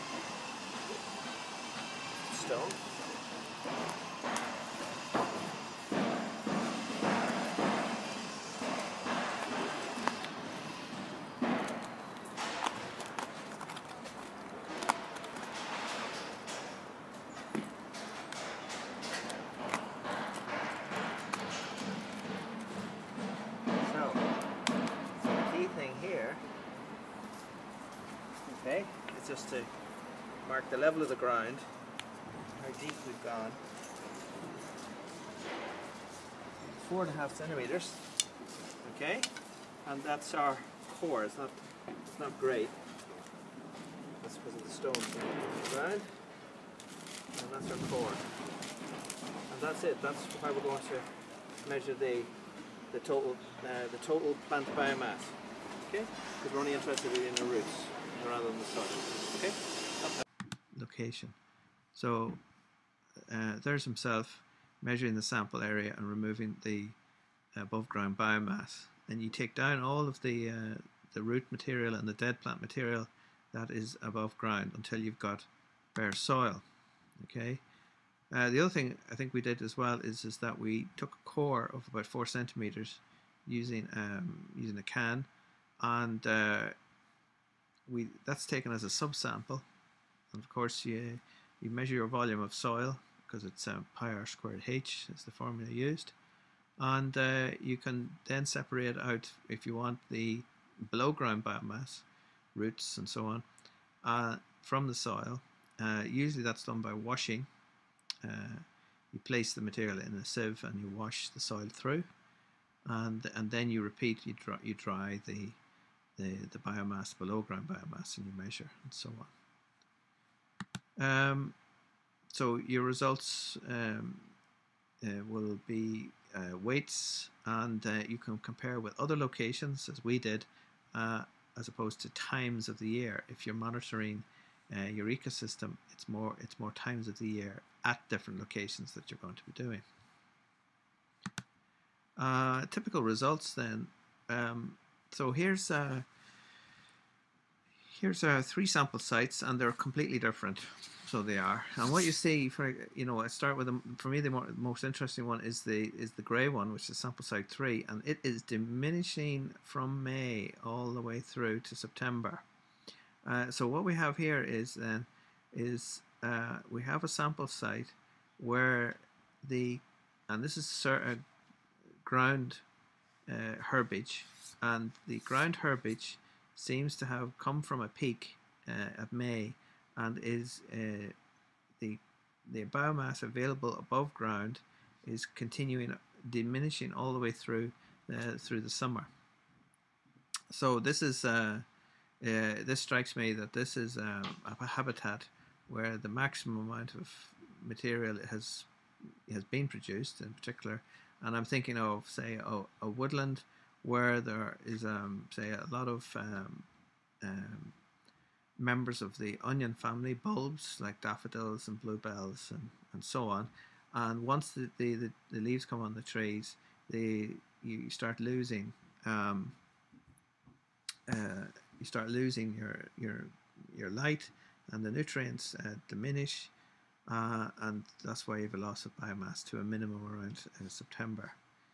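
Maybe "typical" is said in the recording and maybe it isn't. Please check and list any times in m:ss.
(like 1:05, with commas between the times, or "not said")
2:22.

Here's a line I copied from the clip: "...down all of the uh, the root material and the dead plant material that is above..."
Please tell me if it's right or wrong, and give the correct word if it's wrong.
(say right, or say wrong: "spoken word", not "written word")
right.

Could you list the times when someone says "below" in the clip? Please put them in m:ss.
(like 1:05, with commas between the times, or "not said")
1:40, 1:57.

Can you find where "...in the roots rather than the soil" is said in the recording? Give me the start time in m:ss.
0:57.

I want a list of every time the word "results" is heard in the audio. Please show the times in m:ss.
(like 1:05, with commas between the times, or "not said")
2:02, 2:23.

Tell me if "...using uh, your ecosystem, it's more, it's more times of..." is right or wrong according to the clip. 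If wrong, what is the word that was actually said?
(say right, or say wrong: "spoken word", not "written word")
wrong: "monitoring", not "using".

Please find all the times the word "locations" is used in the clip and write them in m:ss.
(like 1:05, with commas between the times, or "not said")
1:00, 2:09, 2:18.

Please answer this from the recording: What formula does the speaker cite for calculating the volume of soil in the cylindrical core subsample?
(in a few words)
pi r squared h.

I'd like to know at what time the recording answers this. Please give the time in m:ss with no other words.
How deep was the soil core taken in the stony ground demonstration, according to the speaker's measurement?
0:36.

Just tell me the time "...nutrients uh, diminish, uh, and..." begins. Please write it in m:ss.
3:44.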